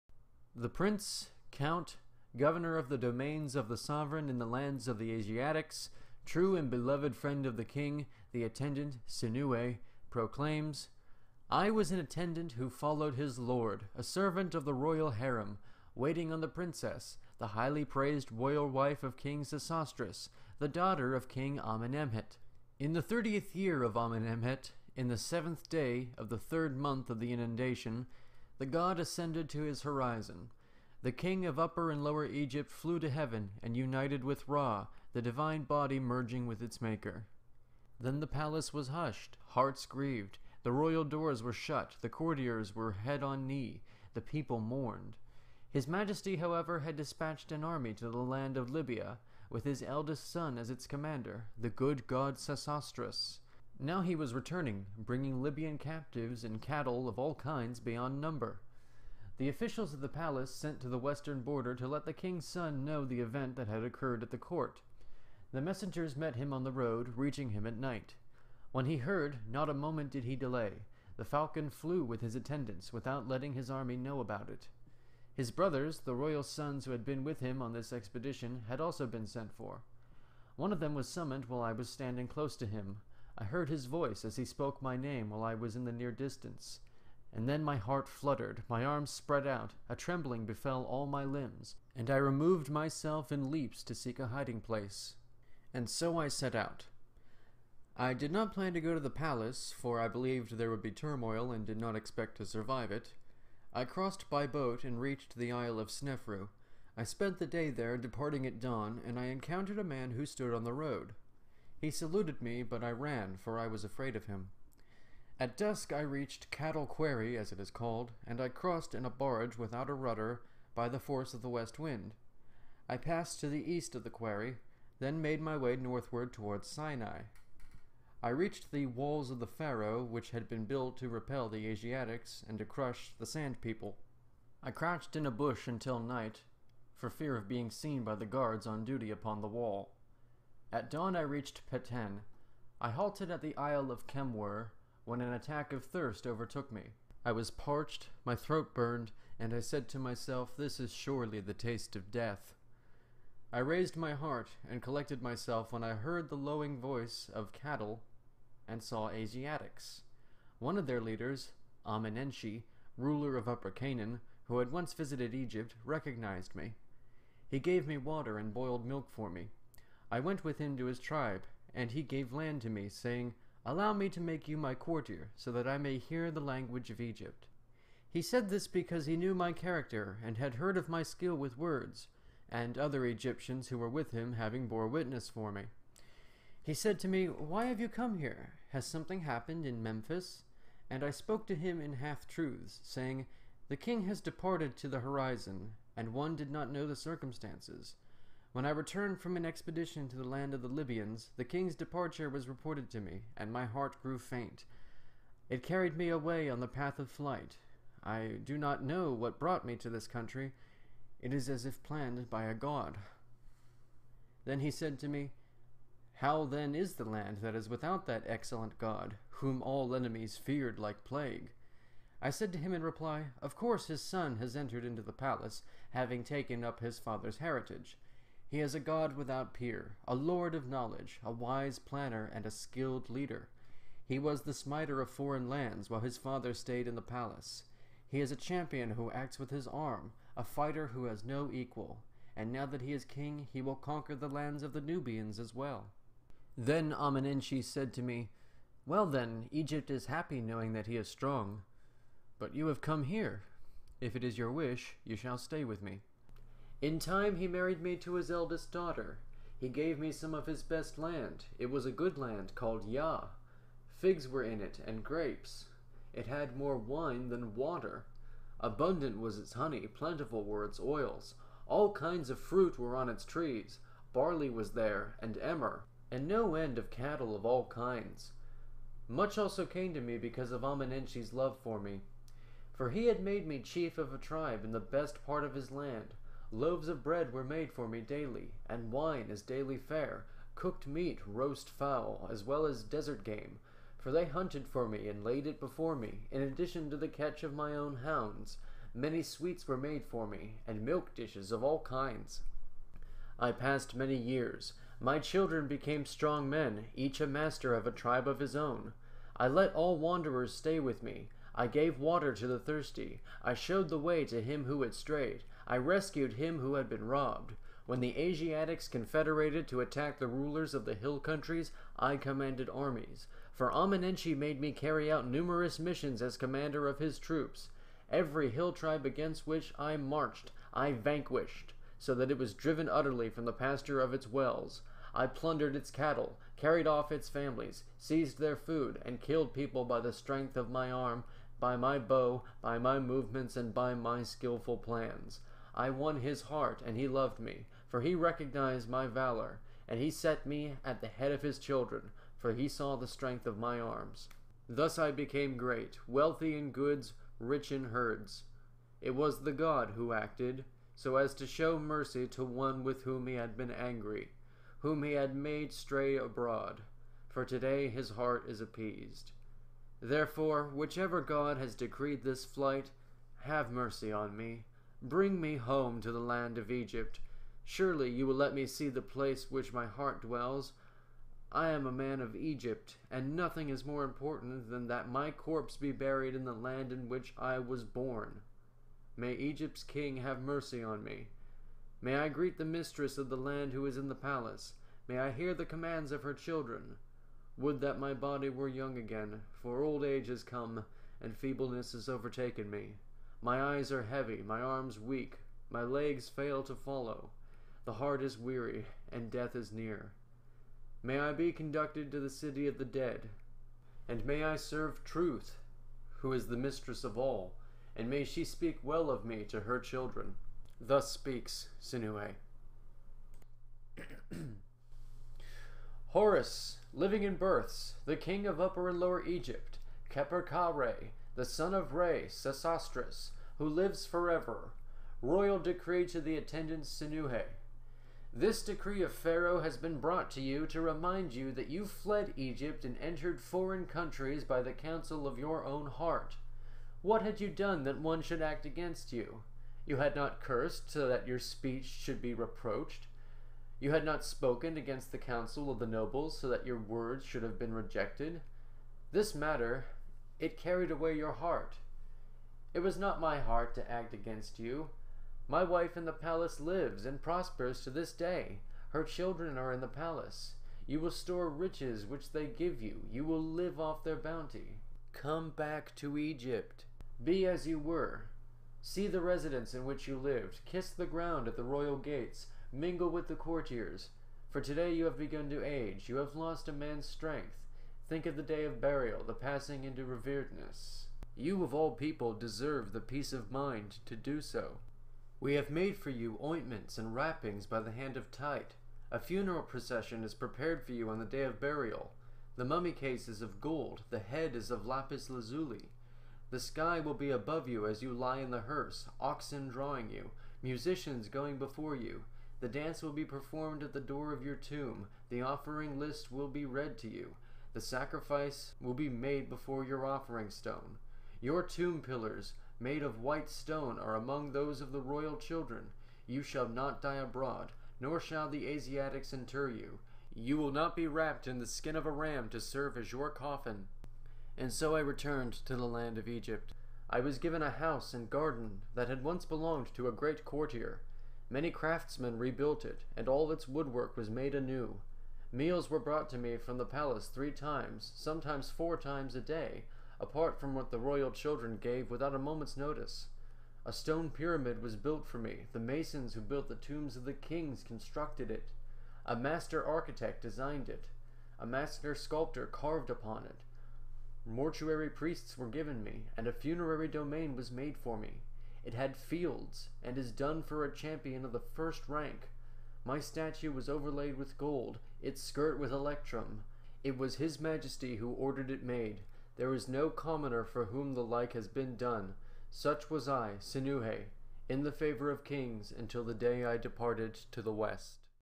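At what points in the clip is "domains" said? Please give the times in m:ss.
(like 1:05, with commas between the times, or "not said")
0:02, 9:27.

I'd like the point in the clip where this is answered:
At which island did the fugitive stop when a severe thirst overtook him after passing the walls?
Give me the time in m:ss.
2:23.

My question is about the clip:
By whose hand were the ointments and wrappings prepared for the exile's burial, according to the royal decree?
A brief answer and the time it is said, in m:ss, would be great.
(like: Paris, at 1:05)
Tite, at 8:18.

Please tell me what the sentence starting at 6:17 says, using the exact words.
Surely you will let me see the place which my heart dwells.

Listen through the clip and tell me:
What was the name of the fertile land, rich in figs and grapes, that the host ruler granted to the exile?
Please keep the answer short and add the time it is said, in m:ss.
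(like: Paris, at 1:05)
Yah, at 4:22.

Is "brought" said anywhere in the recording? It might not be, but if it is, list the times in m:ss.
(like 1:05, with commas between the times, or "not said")
3:29, 7:19, 9:05.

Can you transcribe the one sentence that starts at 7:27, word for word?
What had you done that one should act against you?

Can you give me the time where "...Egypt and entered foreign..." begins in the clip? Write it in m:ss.
7:22.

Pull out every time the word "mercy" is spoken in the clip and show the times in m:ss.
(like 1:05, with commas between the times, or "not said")
6:01, 6:13, 6:30.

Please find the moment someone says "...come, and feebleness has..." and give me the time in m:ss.
6:40.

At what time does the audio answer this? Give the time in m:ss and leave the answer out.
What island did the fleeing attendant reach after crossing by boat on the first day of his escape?
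1:45.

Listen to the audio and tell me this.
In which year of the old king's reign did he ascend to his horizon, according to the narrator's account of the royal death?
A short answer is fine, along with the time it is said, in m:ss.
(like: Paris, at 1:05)
30th year, at 0:23.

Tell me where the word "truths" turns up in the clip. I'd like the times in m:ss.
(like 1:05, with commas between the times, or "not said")
3:12, 6:55.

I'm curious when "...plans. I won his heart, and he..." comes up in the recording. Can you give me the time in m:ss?
5:44.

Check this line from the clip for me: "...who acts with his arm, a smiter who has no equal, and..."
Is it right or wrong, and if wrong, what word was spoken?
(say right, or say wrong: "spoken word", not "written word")
wrong: "fighter", not "smiter".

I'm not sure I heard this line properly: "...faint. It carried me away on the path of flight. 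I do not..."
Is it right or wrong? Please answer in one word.
right.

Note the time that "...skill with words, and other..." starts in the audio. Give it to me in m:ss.
3:01.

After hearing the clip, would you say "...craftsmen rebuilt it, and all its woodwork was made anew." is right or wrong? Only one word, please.
right.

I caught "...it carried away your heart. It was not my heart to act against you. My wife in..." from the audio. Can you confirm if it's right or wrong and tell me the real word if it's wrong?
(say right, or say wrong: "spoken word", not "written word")
right.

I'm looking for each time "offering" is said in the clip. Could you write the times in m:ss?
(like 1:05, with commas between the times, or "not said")
8:35, 8:40.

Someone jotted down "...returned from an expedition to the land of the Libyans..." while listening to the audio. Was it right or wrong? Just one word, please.
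right.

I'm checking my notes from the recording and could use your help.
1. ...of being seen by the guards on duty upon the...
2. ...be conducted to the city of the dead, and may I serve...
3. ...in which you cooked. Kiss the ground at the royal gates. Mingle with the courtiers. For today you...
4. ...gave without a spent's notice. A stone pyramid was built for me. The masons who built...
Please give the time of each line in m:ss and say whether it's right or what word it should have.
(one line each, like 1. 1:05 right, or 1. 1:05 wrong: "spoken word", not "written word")
1. 2:17 right
2. 6:51 right
3. 7:59 wrong: "lived", not "cooked"
4. 9:11 wrong: "moment", not "spent".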